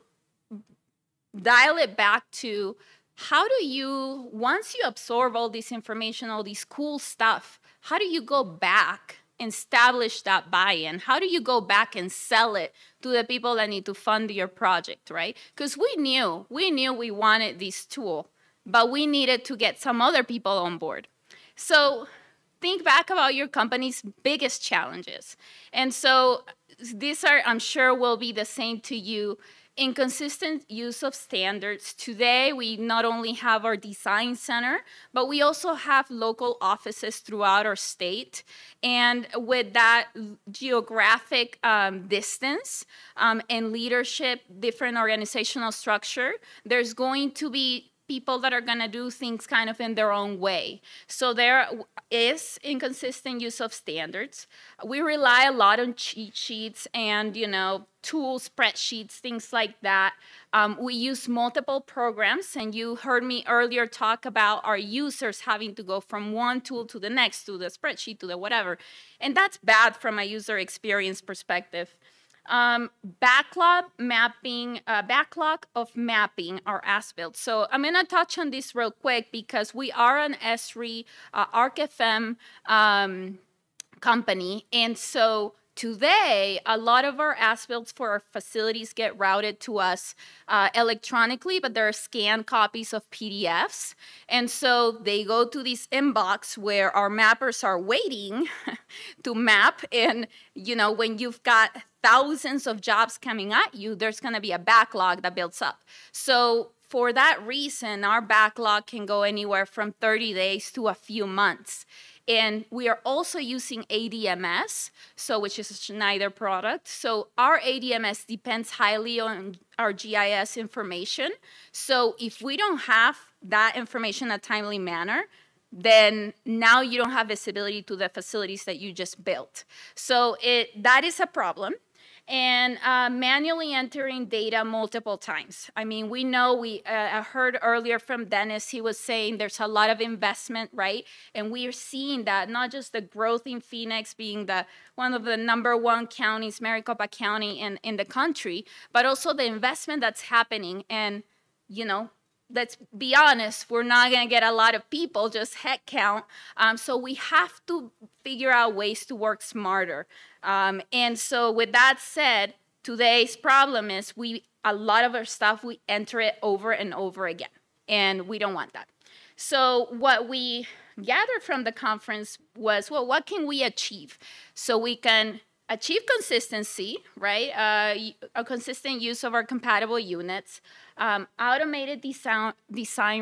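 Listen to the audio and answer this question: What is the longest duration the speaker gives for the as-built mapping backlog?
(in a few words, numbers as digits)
a few months.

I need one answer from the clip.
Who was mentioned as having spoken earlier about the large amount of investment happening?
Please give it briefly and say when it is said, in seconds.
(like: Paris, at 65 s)
Dennis, at 138 s.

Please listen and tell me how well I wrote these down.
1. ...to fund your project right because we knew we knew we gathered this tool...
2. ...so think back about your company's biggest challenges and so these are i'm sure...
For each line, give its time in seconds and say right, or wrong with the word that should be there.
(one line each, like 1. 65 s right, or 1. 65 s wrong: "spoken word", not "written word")
1. 13 s wrong: "wanted", not "gathered"
2. 21 s right.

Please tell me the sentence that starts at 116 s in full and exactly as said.
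So our ADMS depends highly on our GIS information.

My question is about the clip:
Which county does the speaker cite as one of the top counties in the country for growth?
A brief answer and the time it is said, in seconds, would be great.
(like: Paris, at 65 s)
Maricopa County, at 146 s.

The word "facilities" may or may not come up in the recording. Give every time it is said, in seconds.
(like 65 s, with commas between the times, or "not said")
88 s, 128 s.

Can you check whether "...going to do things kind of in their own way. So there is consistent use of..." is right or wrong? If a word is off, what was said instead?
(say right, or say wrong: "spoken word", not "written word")
wrong: "inconsistent", not "consistent".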